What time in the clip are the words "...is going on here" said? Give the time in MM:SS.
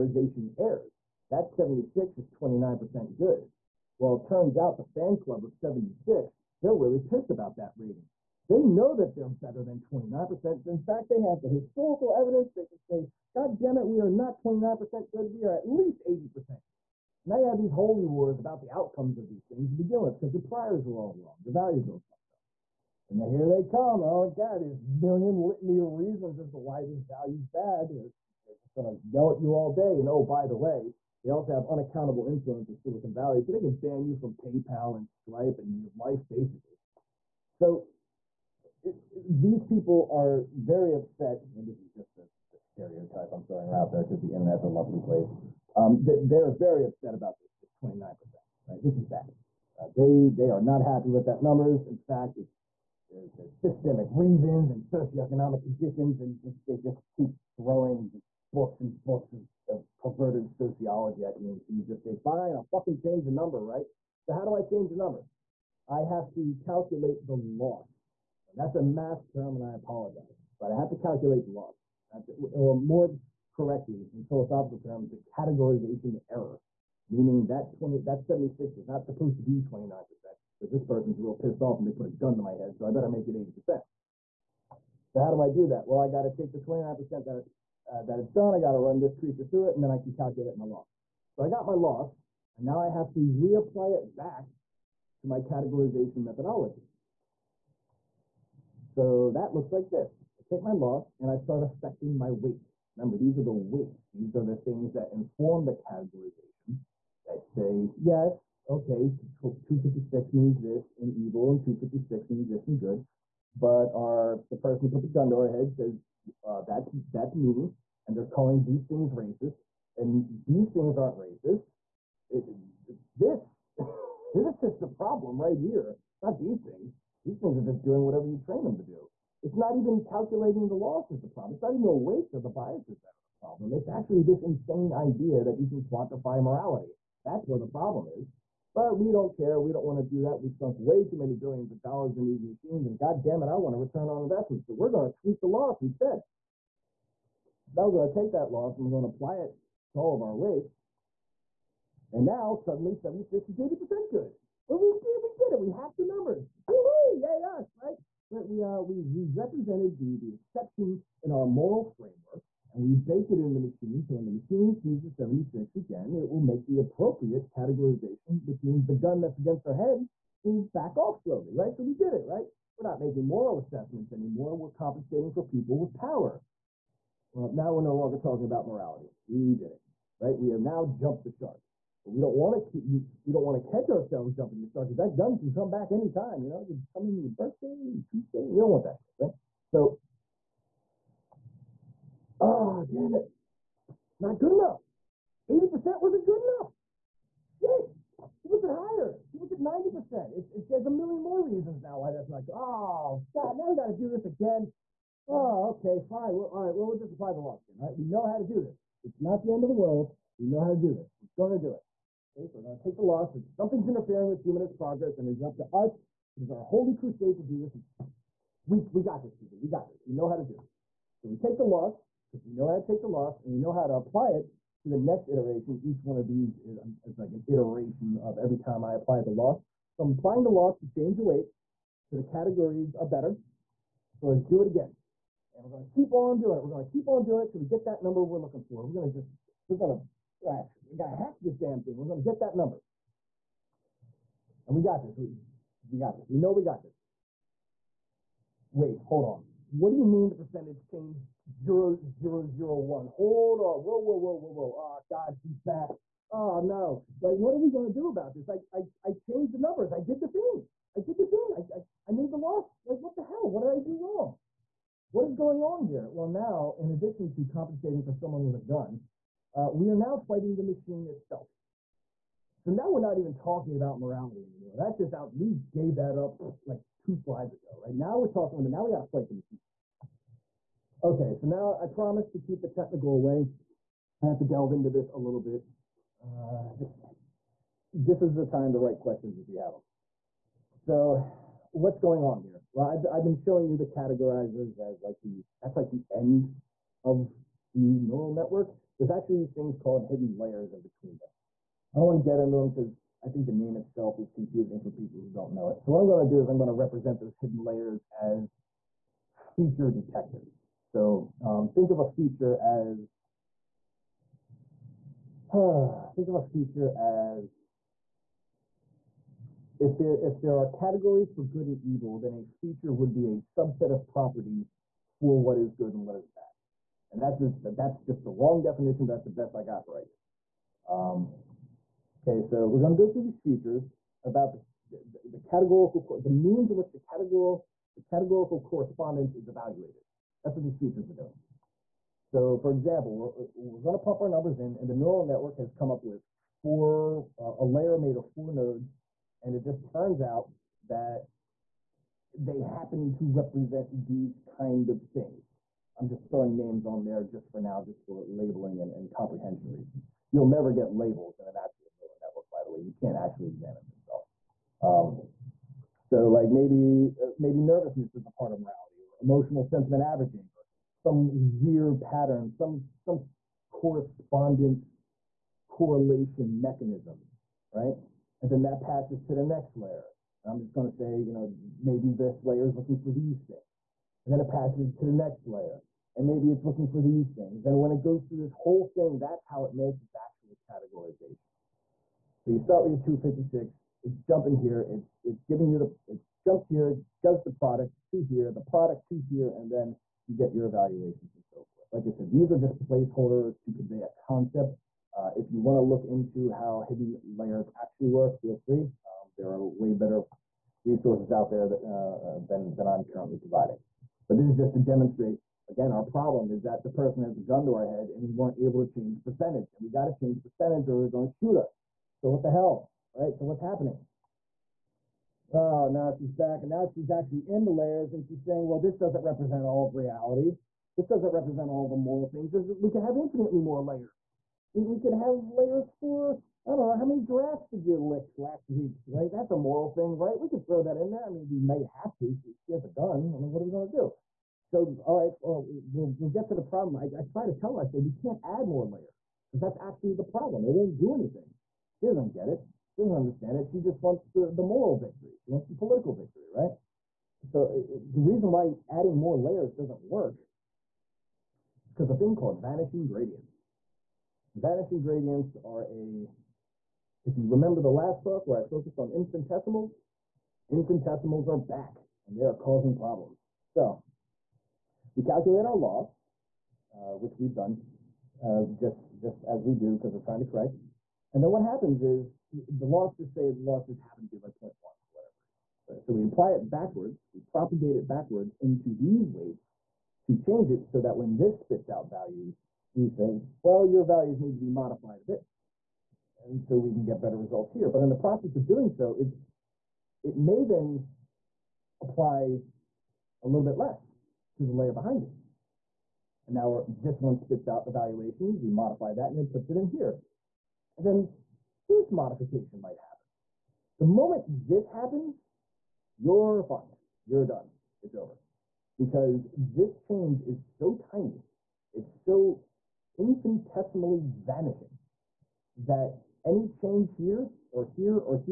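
04:25.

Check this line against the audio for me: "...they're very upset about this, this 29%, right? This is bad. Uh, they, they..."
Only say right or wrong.
right.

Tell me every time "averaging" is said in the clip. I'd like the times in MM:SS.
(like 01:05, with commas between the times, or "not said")
06:10.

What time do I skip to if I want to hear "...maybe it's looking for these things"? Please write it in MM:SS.
06:26.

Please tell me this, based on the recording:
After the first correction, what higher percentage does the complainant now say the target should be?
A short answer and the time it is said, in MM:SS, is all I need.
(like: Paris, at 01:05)
90%, at 03:19.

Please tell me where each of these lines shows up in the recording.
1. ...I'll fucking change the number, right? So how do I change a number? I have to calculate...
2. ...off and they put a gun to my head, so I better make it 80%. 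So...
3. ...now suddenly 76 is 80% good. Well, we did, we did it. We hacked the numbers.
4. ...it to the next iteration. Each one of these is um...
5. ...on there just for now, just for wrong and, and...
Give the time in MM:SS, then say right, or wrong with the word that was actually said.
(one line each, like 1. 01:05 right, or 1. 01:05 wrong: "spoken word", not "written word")
1. 01:02 right
2. 01:21 right
3. 02:32 right
4. 03:44 right
5. 05:56 wrong: "labeling", not "wrong".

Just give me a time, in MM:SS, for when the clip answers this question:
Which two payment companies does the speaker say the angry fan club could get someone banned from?
00:34.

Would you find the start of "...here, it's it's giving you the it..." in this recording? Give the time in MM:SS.
06:34.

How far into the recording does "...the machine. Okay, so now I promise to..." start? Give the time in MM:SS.
04:39.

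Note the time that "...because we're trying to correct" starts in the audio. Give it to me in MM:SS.
07:59.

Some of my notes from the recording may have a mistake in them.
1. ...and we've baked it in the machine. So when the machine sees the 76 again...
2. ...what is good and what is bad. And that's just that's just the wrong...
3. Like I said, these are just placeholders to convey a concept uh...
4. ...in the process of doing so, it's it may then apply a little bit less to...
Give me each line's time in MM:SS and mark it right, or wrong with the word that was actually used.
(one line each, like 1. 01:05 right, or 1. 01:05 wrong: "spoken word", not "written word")
1. 02:42 right
2. 05:25 right
3. 06:41 right
4. 08:18 right.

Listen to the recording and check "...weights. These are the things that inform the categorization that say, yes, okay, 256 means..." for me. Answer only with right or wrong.
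right.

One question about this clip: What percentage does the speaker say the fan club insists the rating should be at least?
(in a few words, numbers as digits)
80%.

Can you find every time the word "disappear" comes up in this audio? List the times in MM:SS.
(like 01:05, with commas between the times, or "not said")
not said.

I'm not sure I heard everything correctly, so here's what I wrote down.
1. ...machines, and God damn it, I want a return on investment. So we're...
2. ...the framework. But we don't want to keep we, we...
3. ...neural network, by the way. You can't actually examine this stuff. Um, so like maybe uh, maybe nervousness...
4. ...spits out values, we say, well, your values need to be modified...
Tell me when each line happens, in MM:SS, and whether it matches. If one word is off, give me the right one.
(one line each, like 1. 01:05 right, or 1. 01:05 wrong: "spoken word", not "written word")
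1. 02:22 right
2. 03:01 wrong: "shark", not "framework"
3. 06:02 right
4. 08:11 right.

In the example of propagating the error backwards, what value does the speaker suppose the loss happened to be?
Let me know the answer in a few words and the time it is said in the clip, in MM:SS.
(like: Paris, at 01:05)
0.1, at 08:04.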